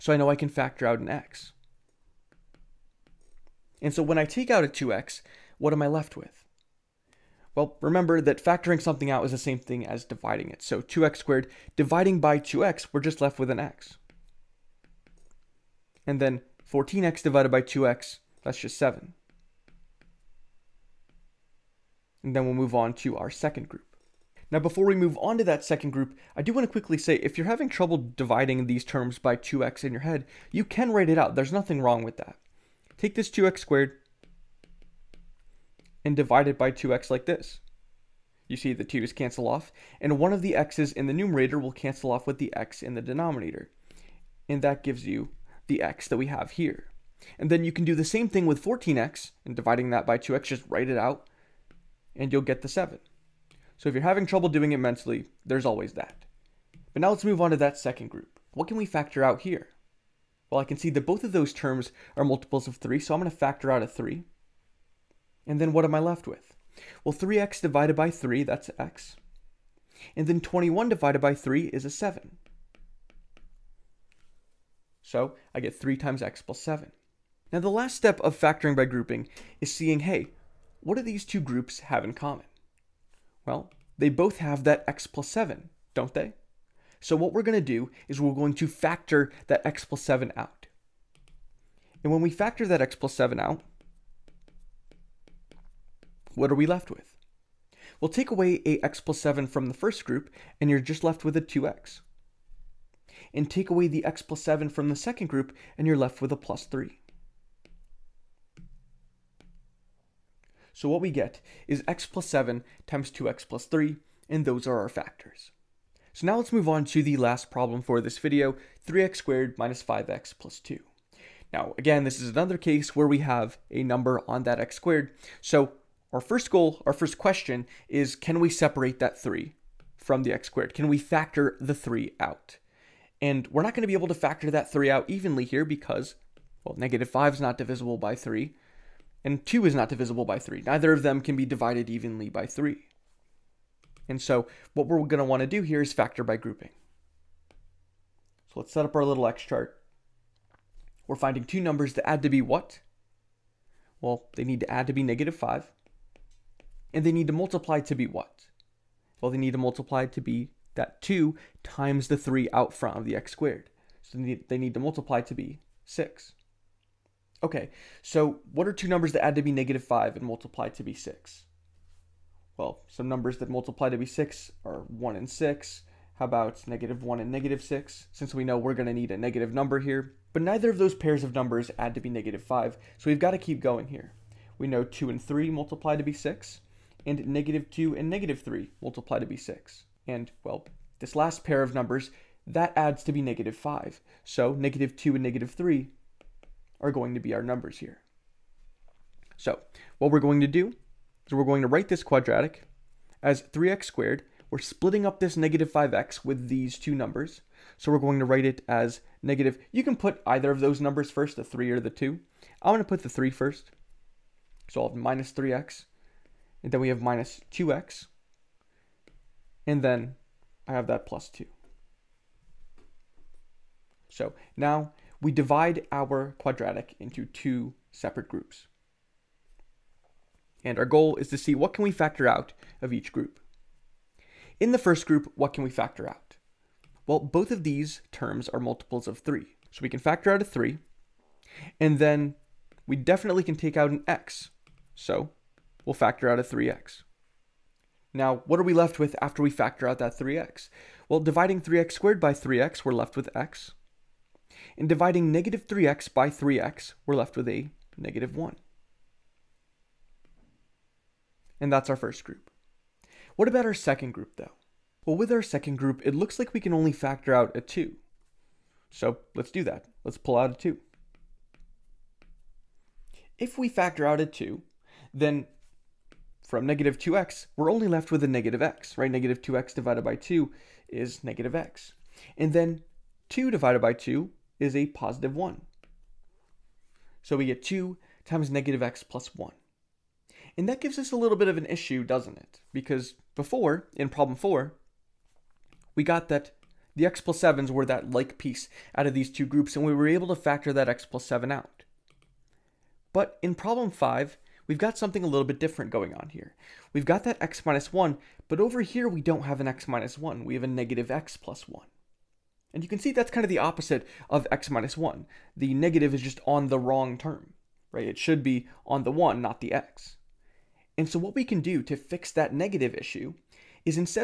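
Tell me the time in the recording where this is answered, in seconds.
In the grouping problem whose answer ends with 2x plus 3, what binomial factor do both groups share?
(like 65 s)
83 s.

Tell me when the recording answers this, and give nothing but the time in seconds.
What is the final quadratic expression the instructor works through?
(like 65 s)
118 s.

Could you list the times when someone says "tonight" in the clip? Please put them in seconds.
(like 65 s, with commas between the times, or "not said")
not said.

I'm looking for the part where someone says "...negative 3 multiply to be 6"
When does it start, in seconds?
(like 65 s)
188 s.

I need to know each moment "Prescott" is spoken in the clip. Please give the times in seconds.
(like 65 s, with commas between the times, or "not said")
not said.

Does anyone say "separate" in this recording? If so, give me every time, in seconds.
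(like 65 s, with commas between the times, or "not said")
128 s, 227 s.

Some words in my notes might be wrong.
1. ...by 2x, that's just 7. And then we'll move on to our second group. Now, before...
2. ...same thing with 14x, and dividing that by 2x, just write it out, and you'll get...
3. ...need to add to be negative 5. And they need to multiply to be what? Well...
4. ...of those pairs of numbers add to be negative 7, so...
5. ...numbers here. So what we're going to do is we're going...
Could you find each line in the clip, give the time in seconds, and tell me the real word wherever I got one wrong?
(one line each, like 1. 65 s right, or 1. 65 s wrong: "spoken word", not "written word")
1. 17 s right
2. 48 s right
3. 154 s right
4. 180 s wrong: "5", not "7"
5. 197 s right.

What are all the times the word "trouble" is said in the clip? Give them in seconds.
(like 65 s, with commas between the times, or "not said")
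27 s, 54 s.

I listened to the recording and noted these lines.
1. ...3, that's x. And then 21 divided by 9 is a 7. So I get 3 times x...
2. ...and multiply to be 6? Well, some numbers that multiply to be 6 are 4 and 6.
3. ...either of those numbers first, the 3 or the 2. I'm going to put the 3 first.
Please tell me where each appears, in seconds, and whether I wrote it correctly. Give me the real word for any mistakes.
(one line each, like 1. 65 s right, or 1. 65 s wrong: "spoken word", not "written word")
1. 68 s wrong: "3", not "9"
2. 170 s wrong: "1", not "4"
3. 210 s right.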